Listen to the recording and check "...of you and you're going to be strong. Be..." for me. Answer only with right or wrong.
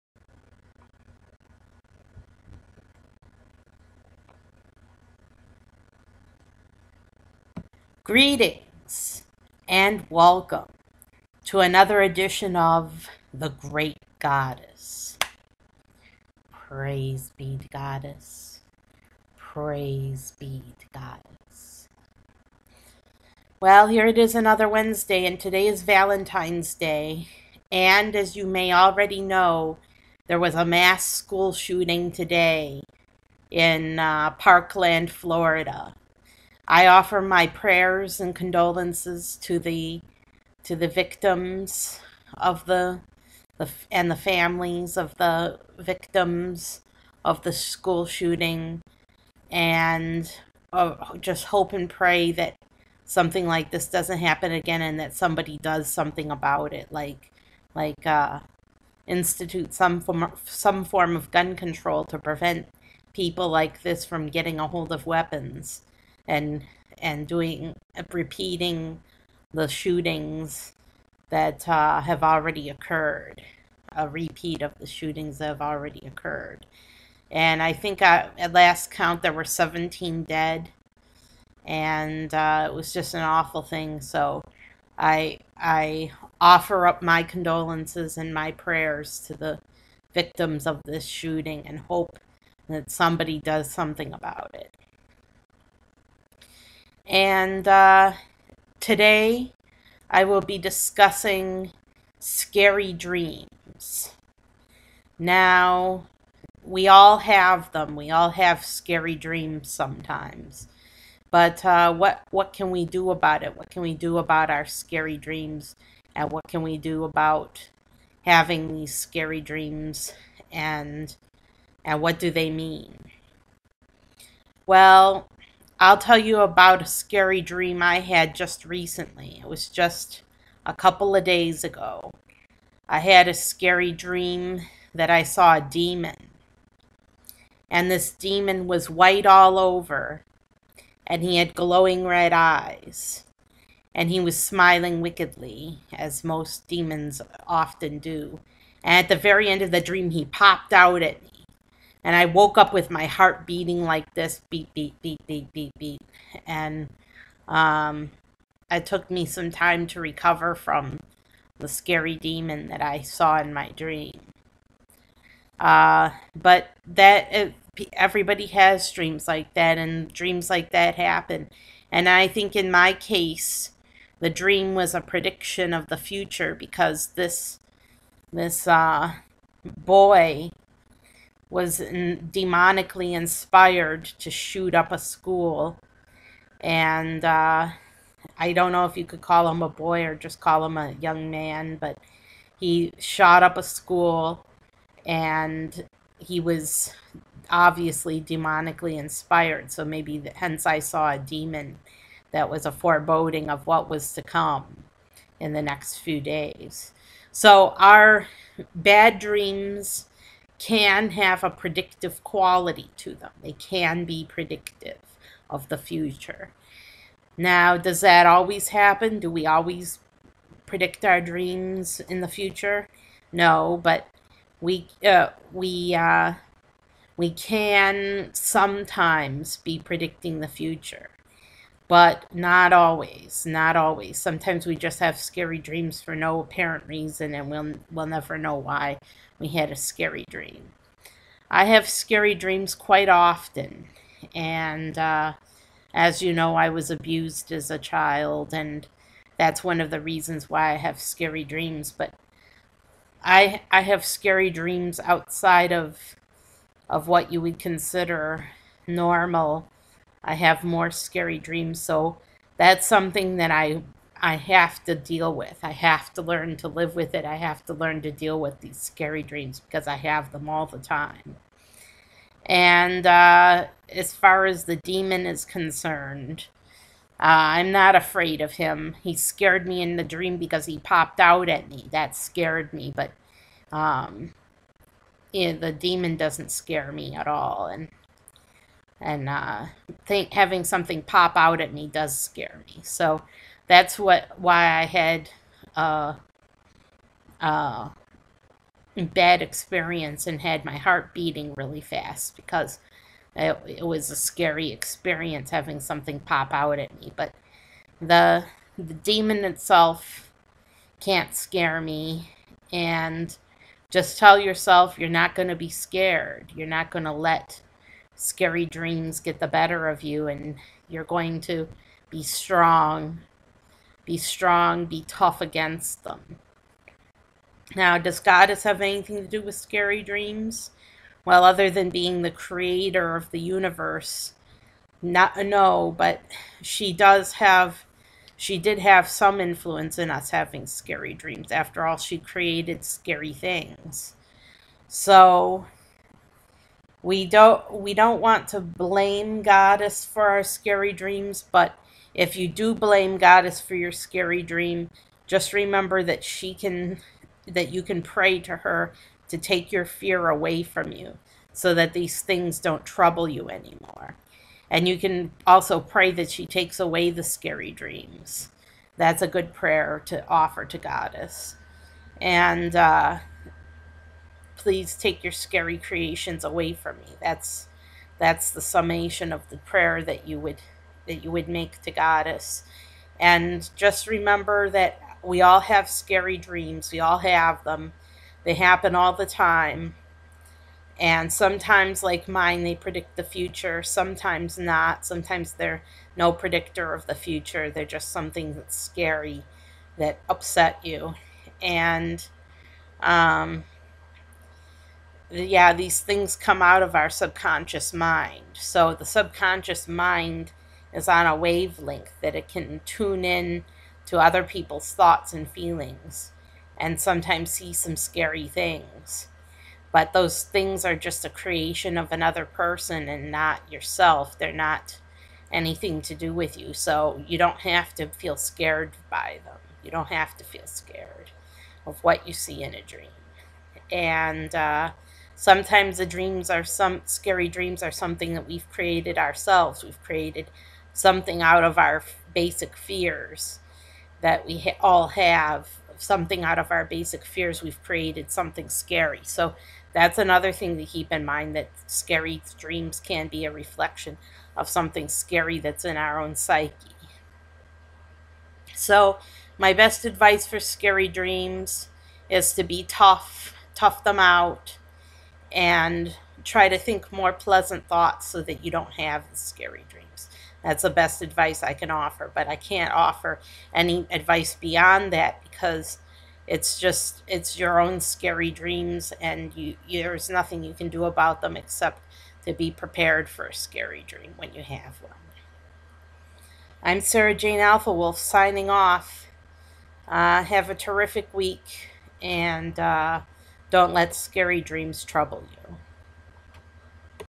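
right.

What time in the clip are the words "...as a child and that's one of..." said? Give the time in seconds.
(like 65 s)
247 s.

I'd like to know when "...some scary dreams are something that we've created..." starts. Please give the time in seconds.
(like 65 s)
436 s.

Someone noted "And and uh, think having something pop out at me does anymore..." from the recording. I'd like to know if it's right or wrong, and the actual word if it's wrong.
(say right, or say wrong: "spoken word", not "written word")
wrong: "scare", not "anymore".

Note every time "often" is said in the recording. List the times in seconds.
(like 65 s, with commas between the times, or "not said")
147 s, 243 s.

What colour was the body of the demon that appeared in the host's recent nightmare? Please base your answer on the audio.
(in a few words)
White.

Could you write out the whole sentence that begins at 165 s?
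Uh, but that it, uh, everybody has dreams like that, and dreams like that happen.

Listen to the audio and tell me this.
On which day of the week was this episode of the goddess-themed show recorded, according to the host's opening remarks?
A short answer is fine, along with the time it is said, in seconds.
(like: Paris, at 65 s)
Wednesday, at 24 s.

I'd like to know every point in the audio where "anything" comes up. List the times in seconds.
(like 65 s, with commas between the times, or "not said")
328 s, 425 s.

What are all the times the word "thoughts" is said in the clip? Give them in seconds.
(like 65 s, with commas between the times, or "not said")
414 s, 467 s.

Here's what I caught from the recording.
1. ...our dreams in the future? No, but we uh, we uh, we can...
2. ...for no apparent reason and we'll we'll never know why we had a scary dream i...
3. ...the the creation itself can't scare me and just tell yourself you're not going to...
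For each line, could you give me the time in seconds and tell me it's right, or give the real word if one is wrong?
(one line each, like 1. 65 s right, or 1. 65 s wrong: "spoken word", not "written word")
1. 221 s right
2. 236 s right
3. 307 s wrong: "demon", not "creation".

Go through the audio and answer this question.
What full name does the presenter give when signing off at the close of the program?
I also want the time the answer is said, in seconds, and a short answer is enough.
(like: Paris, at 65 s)
Sarah Jane Alphawolf, at 487 s.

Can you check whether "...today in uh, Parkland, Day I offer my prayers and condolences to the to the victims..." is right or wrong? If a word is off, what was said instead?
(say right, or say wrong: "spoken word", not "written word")
wrong: "Florida", not "Day".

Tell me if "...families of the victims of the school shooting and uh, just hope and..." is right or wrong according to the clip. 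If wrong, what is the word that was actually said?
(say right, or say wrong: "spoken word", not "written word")
right.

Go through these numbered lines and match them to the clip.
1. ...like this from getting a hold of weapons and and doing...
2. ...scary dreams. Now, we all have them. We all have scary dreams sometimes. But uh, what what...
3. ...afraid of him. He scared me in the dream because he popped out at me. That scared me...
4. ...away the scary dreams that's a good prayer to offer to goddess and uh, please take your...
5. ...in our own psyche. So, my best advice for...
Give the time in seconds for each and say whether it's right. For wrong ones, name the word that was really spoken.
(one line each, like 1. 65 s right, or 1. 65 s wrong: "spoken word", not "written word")
1. 63 s right
2. 102 s right
3. 277 s right
4. 366 s right
5. 455 s right.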